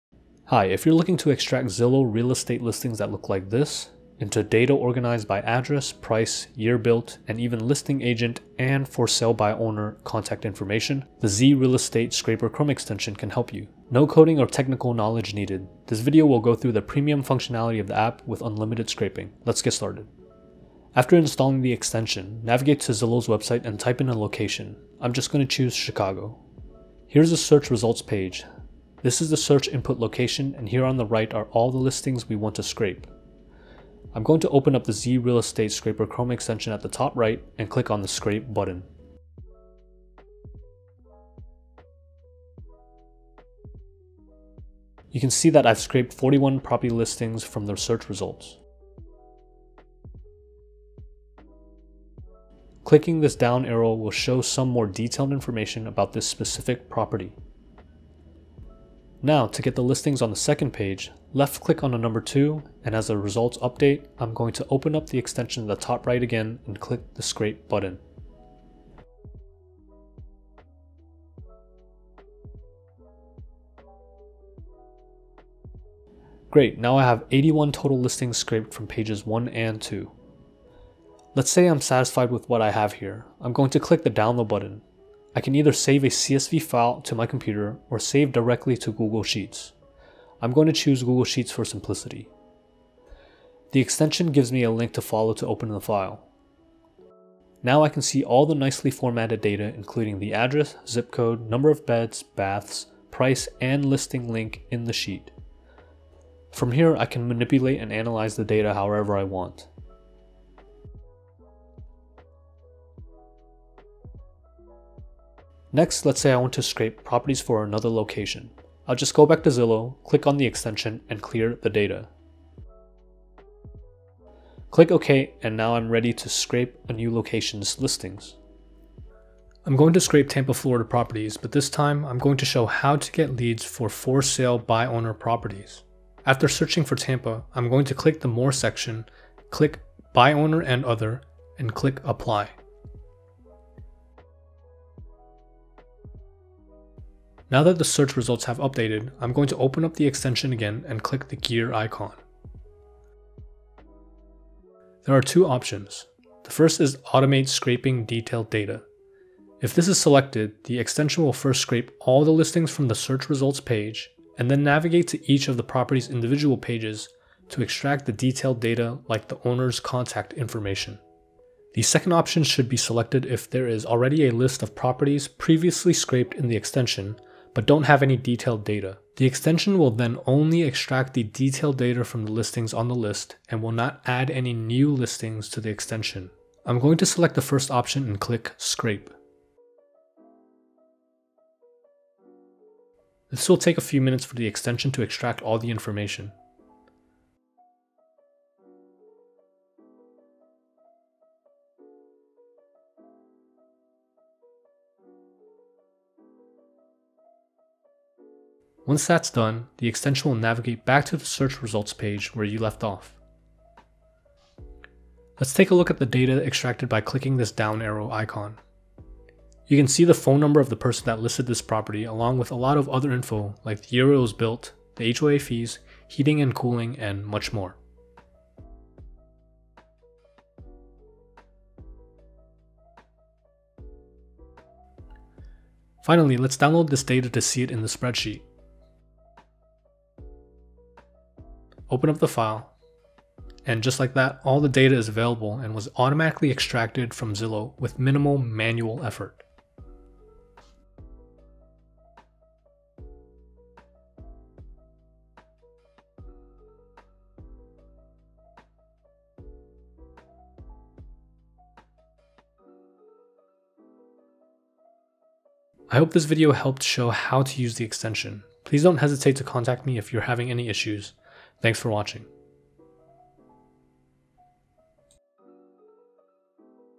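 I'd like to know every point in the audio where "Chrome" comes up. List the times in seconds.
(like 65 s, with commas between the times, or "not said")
12 s, 36 s.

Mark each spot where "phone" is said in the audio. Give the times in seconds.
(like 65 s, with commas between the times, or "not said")
220 s.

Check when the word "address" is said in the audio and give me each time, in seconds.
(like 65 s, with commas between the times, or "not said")
5 s, 100 s.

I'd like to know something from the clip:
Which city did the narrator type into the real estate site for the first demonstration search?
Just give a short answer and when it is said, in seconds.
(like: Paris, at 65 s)
Chicago, at 25 s.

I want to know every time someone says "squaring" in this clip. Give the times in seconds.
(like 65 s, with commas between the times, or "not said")
not said.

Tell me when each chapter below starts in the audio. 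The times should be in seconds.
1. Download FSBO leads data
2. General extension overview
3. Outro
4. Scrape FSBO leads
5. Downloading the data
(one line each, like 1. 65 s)
1. 235 s
2. 20 s
3. 265 s
4. 115 s
5. 76 s.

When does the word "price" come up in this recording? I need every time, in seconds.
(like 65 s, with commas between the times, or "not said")
5 s, 103 s.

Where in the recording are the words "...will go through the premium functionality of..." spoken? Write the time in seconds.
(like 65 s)
16 s.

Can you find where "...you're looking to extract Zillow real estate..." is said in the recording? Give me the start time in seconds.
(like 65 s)
0 s.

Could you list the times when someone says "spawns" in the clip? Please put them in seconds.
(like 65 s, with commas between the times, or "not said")
not said.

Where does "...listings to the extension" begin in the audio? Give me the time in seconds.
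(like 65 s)
184 s.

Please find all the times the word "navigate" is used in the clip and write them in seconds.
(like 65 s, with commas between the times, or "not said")
22 s, 164 s, 210 s.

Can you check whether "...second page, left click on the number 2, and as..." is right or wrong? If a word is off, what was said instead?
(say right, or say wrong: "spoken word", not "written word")
right.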